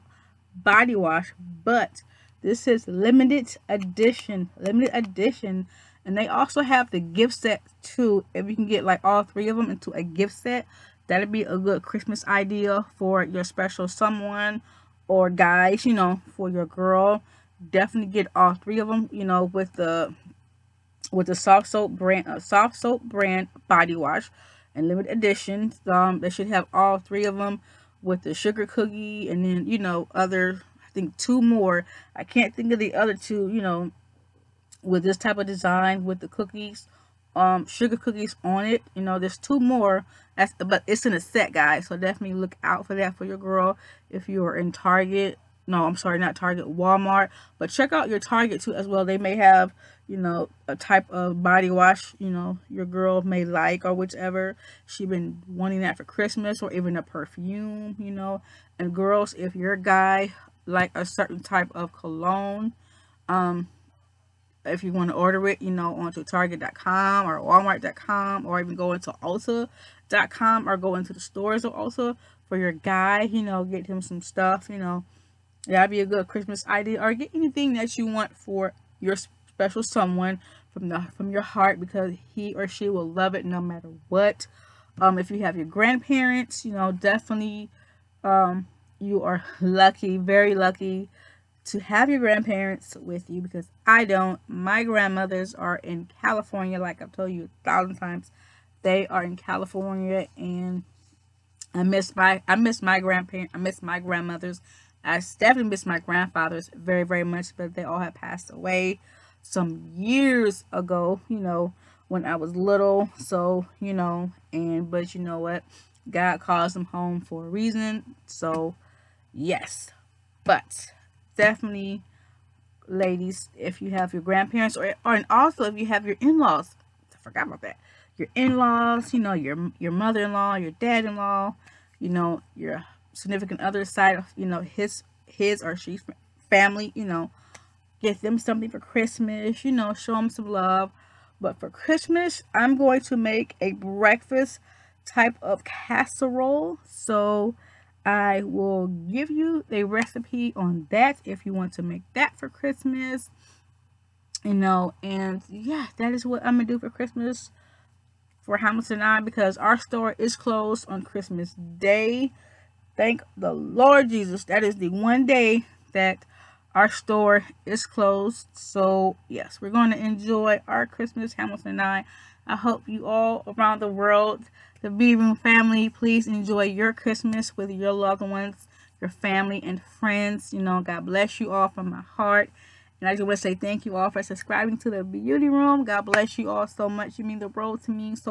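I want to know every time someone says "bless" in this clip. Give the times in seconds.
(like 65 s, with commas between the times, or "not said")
181 s, 186 s.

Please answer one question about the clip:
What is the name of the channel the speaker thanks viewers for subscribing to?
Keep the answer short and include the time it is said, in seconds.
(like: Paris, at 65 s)
The Beauty Room, at 184 s.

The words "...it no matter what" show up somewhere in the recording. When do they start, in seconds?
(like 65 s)
83 s.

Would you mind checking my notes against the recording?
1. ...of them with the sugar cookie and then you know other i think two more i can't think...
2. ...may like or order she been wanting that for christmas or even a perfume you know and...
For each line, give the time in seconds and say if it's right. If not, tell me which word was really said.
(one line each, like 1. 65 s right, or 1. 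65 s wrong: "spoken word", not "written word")
1. 27 s right
2. 53 s wrong: "whichever", not "order".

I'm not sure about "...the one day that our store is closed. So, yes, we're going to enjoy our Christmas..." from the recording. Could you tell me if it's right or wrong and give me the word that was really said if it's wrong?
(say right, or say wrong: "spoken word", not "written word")
right.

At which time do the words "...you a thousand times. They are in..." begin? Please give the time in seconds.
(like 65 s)
97 s.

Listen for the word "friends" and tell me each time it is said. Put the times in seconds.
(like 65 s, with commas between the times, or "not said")
179 s.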